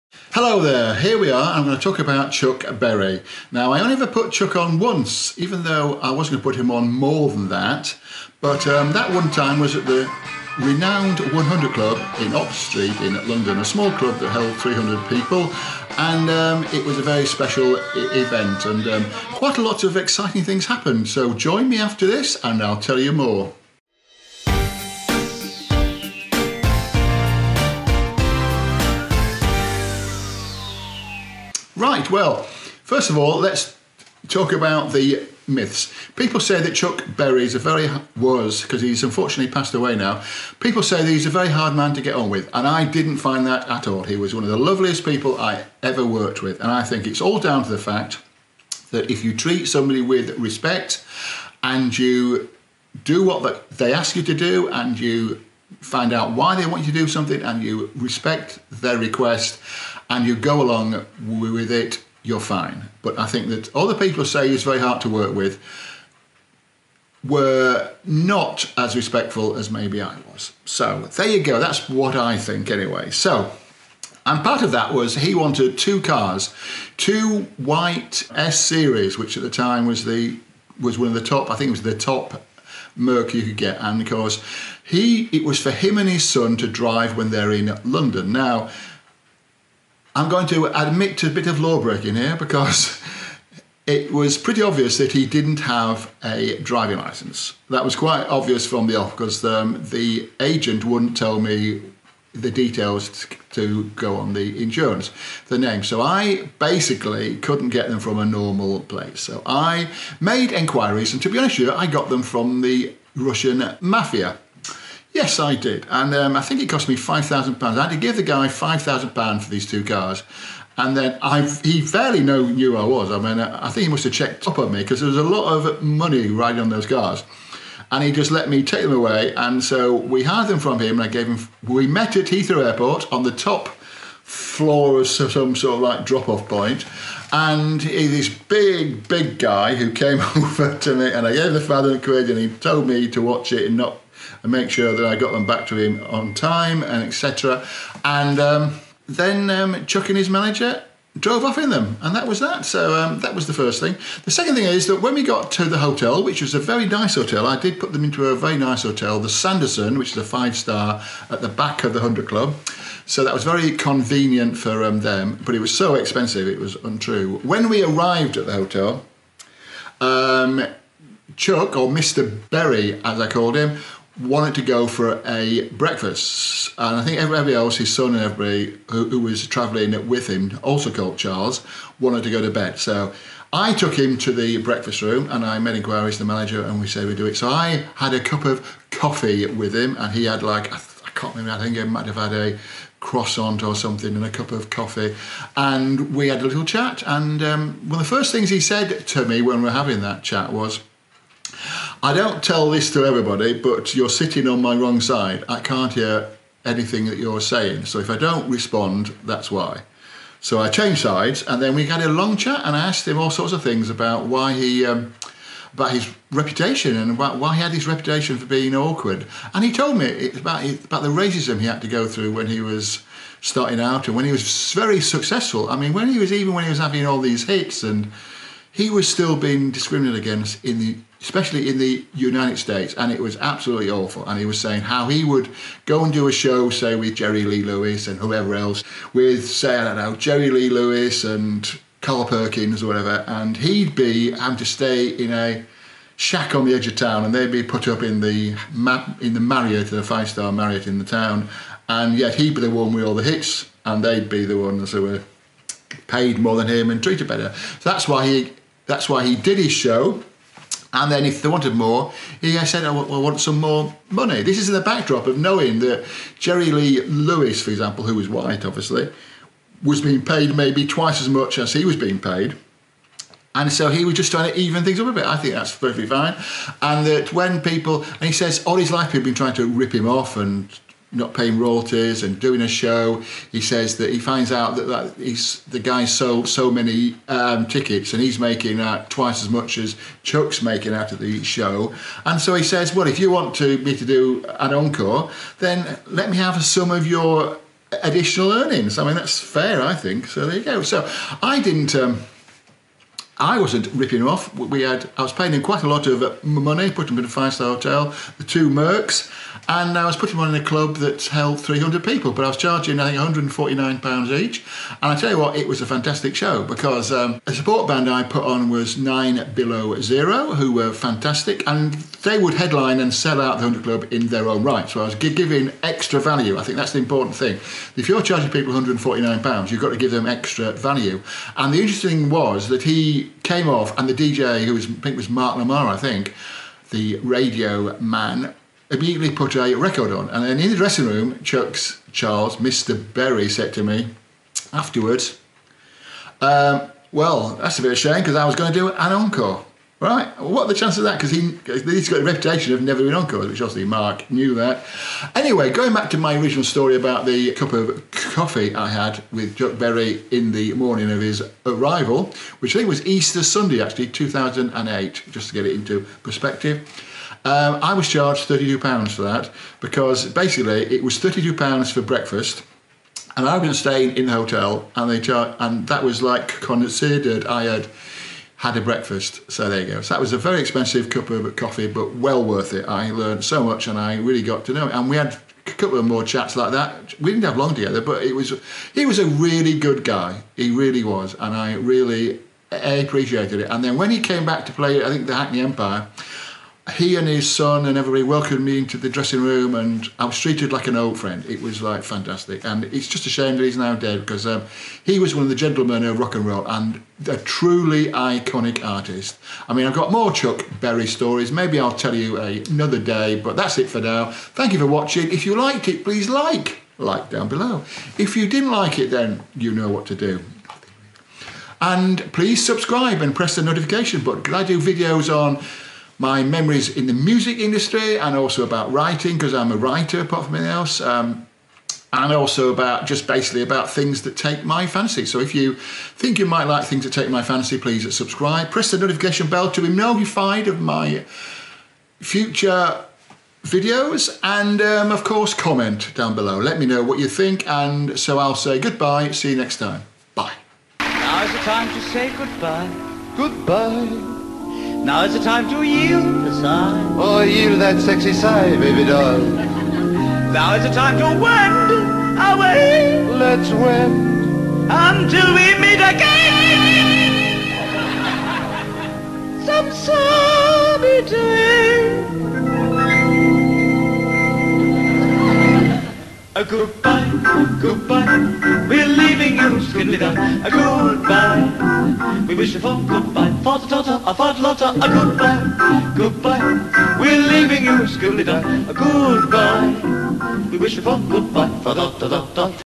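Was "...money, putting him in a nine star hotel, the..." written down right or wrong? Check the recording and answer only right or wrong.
wrong.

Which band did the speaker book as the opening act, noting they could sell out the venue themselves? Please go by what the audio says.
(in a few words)
Nine Below Zero.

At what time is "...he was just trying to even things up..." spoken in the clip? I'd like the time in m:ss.
4:33.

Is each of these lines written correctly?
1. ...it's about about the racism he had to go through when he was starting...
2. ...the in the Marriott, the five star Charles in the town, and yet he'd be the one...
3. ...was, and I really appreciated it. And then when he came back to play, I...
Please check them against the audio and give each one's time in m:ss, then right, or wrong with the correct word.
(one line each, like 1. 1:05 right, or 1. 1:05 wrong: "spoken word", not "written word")
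1. 3:40 right
2. 4:08 wrong: "Marriott", not "Charles"
3. 6:31 right.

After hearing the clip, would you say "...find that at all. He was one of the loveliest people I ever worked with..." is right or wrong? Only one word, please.
right.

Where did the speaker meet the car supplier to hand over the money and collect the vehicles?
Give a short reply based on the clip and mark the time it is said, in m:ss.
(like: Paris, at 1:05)
Heathrow Airport, at 2:12.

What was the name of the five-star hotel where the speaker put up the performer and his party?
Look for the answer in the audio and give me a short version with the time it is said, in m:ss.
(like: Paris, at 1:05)
The Sanderson, at 2:39.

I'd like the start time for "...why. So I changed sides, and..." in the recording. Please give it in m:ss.
3:29.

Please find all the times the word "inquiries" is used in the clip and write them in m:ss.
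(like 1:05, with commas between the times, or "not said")
3:05.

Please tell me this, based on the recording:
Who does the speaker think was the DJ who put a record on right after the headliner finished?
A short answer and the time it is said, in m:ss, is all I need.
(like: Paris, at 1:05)
Mark Lamarr, at 5:35.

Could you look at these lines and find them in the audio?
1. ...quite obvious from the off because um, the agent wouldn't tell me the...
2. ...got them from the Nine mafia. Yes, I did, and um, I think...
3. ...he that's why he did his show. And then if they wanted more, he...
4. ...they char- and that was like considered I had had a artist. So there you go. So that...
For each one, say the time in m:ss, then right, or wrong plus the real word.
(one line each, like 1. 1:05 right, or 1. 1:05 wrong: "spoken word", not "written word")
1. 1:37 right
2. 1:51 wrong: "Russian", not "Nine"
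3. 4:18 right
4. 6:15 wrong: "breakfast", not "artist".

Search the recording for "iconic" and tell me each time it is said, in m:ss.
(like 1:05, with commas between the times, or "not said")
6:48.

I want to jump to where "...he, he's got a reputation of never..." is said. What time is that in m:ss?
5:51.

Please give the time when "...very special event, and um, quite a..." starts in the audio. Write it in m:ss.
0:17.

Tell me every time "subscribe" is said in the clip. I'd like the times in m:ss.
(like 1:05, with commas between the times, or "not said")
7:02, 7:18.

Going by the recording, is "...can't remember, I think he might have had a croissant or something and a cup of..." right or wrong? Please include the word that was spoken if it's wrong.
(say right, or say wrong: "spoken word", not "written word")
right.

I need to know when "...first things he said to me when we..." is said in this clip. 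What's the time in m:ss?
3:18.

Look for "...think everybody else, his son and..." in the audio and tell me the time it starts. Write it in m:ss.
2:57.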